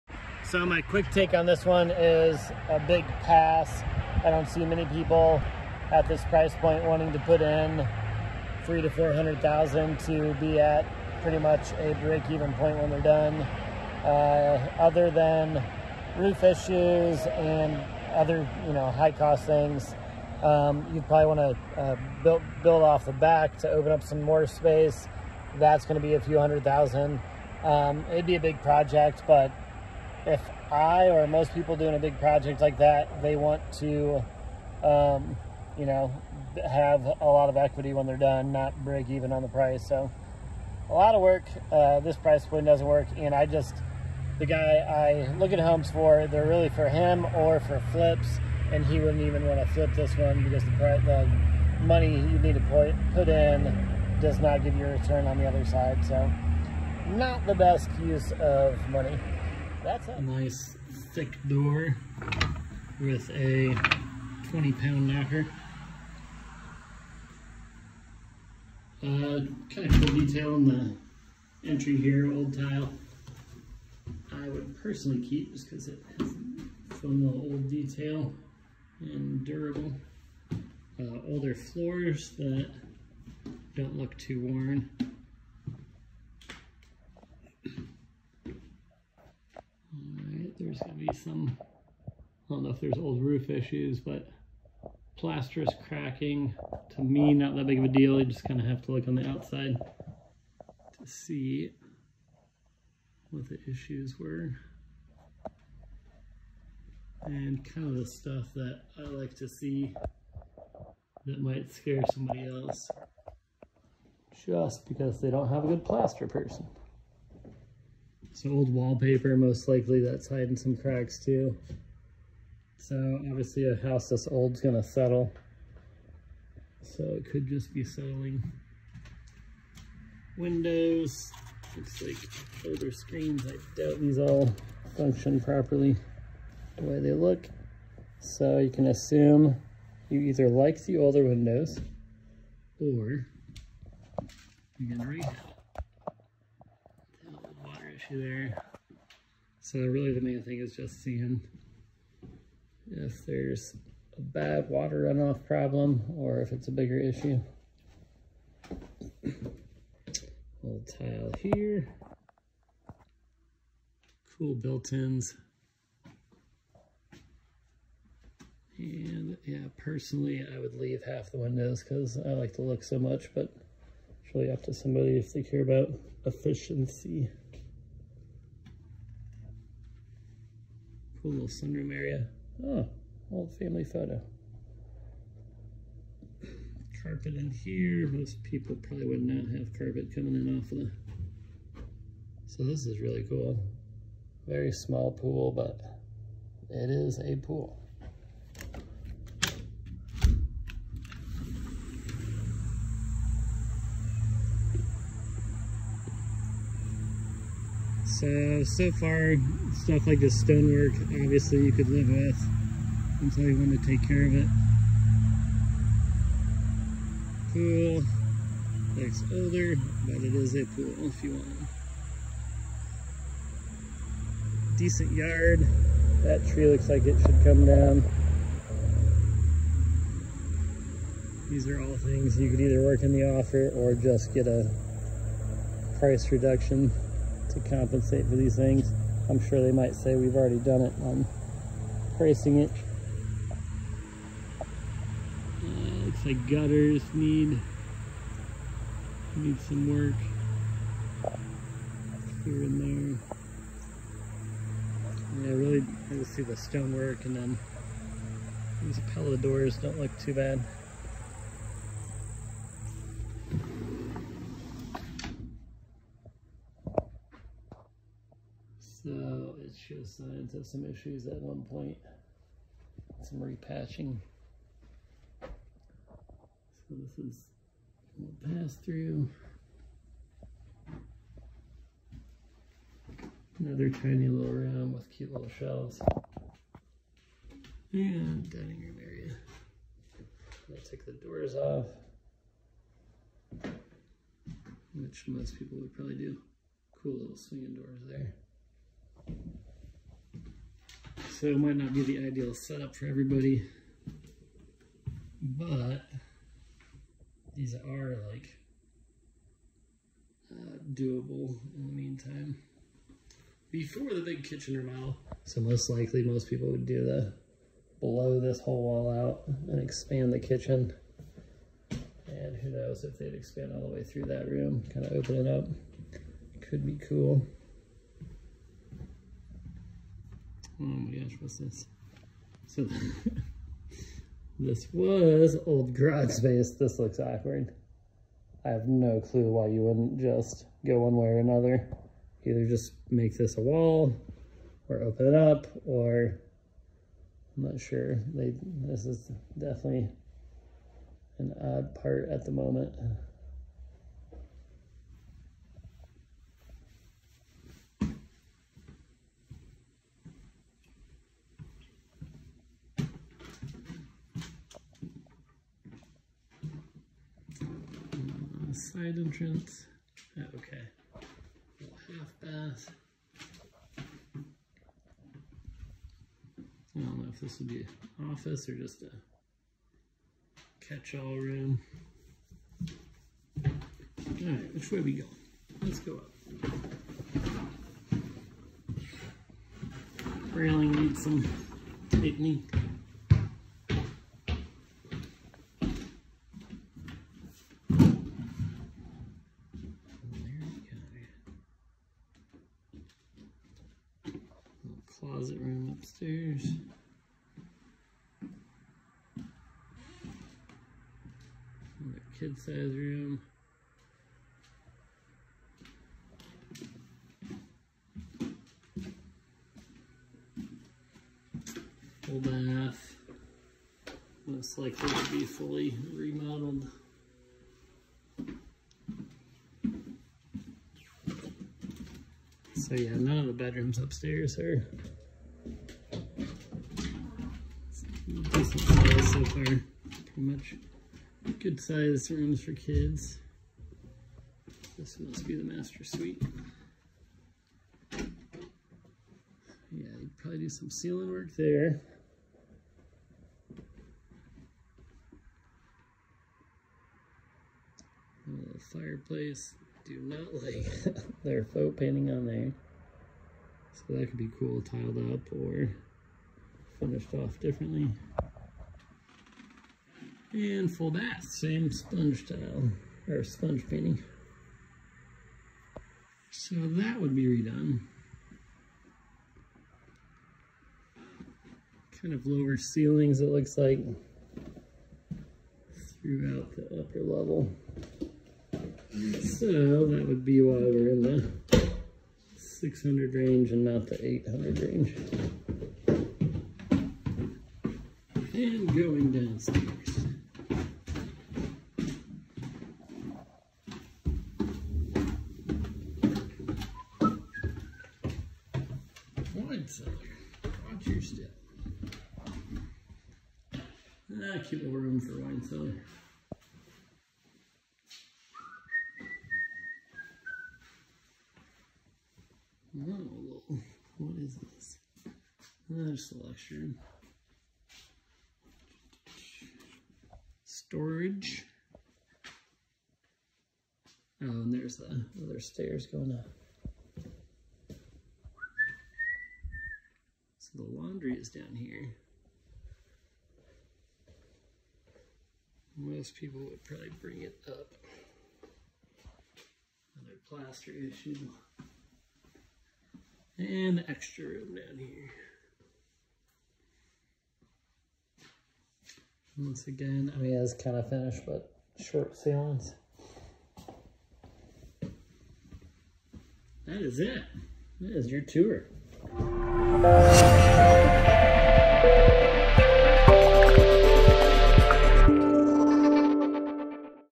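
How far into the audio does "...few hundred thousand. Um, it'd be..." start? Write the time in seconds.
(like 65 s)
26 s.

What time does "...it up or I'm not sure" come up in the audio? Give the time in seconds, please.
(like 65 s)
345 s.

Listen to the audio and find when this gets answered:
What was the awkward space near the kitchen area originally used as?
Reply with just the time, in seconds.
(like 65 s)
335 s.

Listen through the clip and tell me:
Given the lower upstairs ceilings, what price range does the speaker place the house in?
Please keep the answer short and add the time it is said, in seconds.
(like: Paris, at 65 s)
600 range, at 492 s.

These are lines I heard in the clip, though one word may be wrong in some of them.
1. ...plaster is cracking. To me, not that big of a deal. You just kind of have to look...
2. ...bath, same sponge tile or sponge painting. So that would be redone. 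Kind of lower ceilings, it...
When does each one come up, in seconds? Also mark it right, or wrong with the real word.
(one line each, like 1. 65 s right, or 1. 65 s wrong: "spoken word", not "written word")
1. 95 s right
2. 471 s right.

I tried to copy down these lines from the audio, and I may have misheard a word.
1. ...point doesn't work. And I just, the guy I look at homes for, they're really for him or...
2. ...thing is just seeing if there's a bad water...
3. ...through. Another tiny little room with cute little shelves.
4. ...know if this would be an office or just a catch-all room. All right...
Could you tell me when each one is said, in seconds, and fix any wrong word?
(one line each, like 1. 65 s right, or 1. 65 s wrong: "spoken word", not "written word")
1. 42 s right
2. 150 s right
3. 278 s right
4. 377 s right.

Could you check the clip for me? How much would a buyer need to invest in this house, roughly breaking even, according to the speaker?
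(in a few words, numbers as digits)
300,000 to 400,000.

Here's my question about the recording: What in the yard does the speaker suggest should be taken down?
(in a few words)
That tree.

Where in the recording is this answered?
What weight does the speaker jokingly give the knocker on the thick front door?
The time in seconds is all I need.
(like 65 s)
64 s.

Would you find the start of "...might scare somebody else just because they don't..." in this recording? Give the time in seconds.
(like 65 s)
111 s.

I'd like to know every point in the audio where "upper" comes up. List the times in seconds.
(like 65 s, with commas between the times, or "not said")
486 s.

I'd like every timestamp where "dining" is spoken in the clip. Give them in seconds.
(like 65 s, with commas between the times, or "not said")
288 s.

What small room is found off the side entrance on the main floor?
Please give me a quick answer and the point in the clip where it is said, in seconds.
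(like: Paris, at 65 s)
Half bath, at 372 s.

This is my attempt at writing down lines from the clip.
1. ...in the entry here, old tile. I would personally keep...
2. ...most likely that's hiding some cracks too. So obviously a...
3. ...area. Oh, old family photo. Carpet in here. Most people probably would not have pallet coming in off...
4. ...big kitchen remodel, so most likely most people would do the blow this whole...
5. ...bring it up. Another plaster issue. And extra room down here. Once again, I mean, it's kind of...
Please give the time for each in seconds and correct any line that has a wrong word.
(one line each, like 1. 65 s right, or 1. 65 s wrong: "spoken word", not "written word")
1. 70 s right
2. 119 s right
3. 181 s wrong: "carpet", not "pallet"
4. 314 s right
5. 547 s right.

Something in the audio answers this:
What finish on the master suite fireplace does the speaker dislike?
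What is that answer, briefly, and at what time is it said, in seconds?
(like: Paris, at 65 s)
Faux painting, at 461 s.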